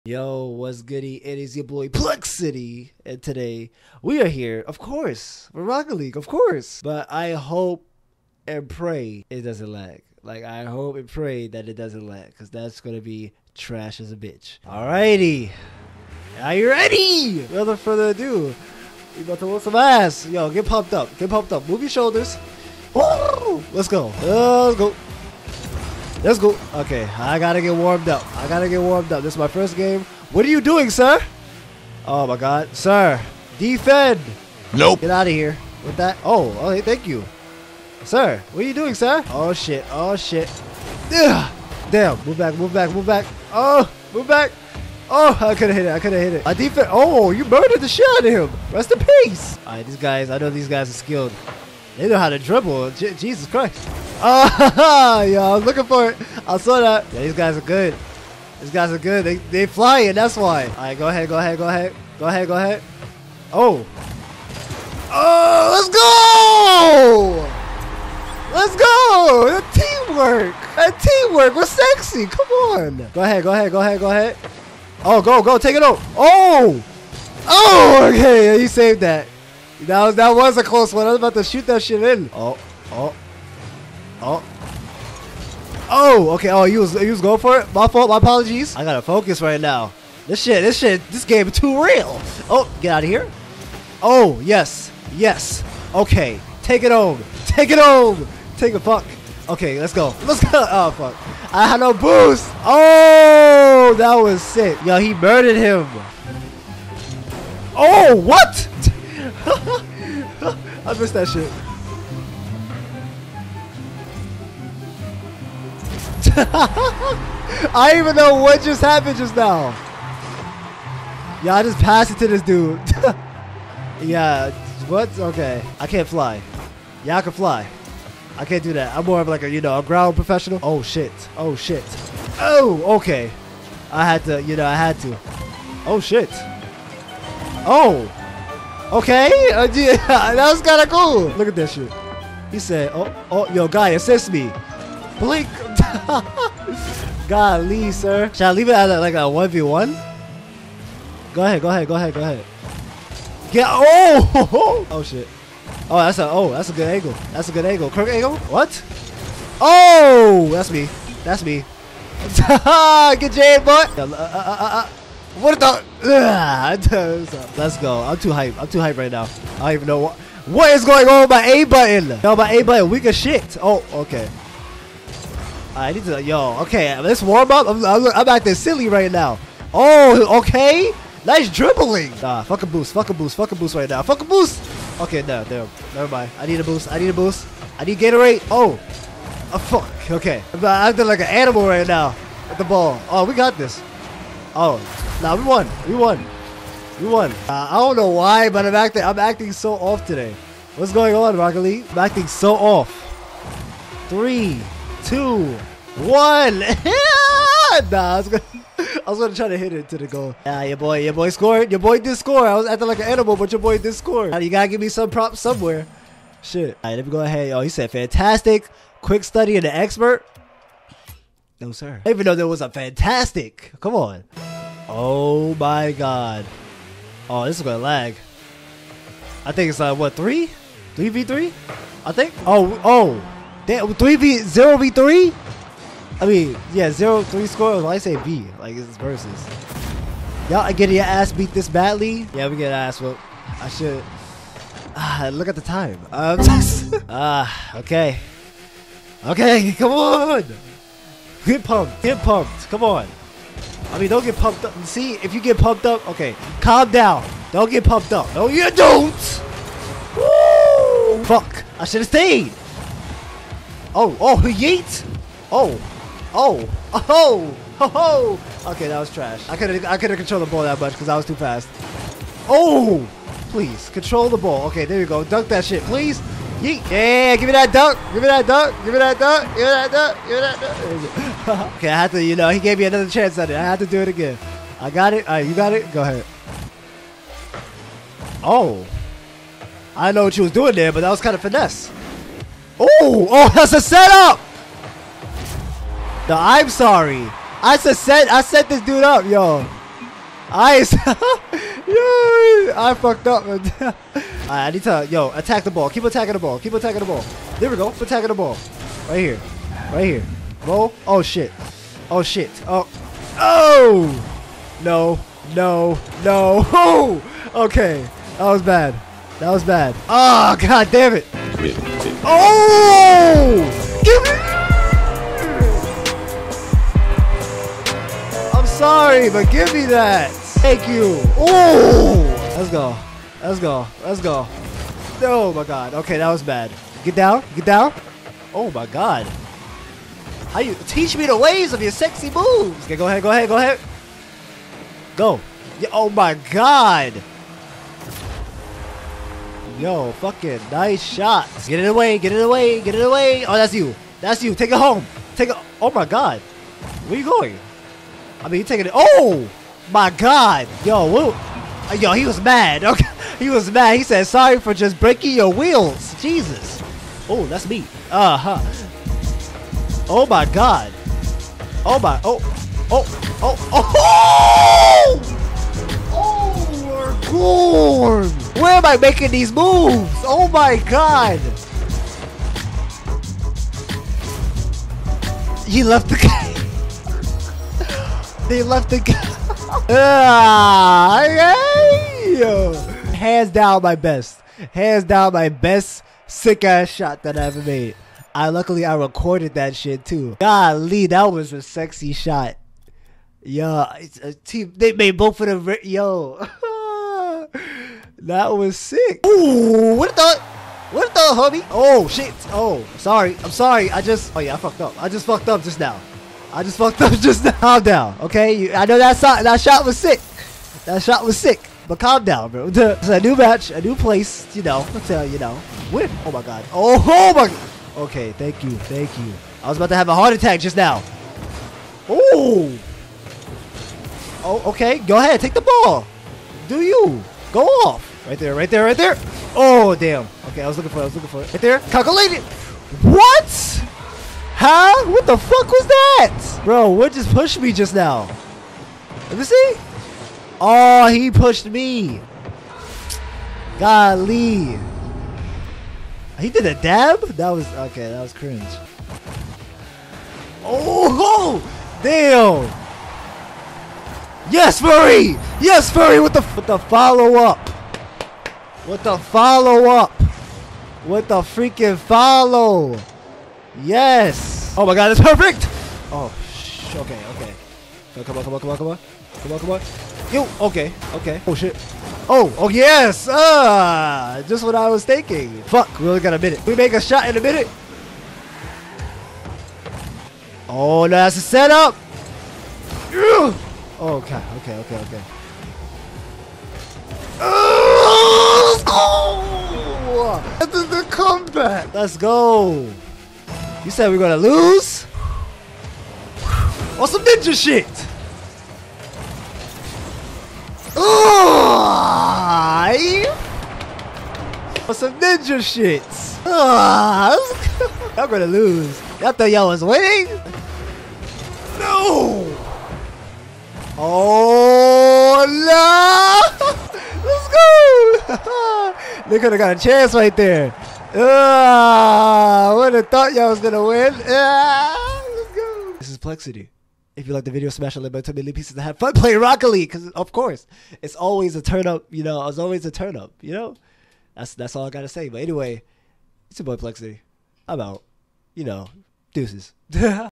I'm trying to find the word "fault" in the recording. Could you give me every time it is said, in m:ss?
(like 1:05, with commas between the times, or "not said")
1:27.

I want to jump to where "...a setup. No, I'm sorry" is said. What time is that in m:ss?
4:53.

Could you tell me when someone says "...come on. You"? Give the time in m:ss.
7:59.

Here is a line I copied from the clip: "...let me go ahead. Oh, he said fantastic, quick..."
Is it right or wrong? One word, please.
right.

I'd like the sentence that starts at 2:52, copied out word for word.
No, my A button weak as shit.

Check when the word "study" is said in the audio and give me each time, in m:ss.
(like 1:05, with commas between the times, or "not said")
3:39.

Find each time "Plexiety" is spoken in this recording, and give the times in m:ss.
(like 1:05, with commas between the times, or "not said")
0:01, 8:56, 9:06.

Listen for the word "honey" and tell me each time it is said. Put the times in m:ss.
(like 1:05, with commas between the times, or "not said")
not said.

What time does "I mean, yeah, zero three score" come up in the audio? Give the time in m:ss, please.
3:56.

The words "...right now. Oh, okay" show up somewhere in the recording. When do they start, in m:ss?
2:58.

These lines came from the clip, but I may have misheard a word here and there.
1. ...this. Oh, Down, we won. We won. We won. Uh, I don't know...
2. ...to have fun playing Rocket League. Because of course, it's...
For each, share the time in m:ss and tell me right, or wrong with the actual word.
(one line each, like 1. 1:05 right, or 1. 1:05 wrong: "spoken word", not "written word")
1. 3:13 wrong: "Nah", not "Down"
2. 8:58 right.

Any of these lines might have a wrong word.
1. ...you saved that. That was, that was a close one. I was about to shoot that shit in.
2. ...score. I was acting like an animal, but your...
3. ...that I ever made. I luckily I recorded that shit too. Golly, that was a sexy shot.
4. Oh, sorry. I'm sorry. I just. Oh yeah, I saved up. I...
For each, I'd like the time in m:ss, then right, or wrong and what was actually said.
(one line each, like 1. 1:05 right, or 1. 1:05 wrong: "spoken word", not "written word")
1. 1:18 right
2. 3:32 right
3. 6:37 right
4. 6:52 wrong: "fucked", not "saved".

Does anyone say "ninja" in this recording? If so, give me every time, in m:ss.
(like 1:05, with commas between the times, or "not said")
8:27, 8:35.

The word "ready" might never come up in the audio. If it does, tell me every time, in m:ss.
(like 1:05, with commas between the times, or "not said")
0:16.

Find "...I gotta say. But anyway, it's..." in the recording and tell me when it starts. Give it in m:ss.
9:04.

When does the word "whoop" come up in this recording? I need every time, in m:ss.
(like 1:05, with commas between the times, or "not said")
4:02.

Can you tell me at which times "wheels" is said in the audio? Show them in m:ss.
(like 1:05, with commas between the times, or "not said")
6:05.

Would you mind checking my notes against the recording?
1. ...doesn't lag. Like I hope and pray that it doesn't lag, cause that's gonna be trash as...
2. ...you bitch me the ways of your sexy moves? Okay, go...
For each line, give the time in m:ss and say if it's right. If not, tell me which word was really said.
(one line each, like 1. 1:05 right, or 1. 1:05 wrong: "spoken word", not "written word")
1. 0:09 right
2. 5:40 wrong: "teach", not "bitch".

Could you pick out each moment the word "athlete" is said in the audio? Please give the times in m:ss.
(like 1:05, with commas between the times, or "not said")
not said.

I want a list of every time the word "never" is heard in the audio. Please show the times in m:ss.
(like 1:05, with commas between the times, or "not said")
3:05.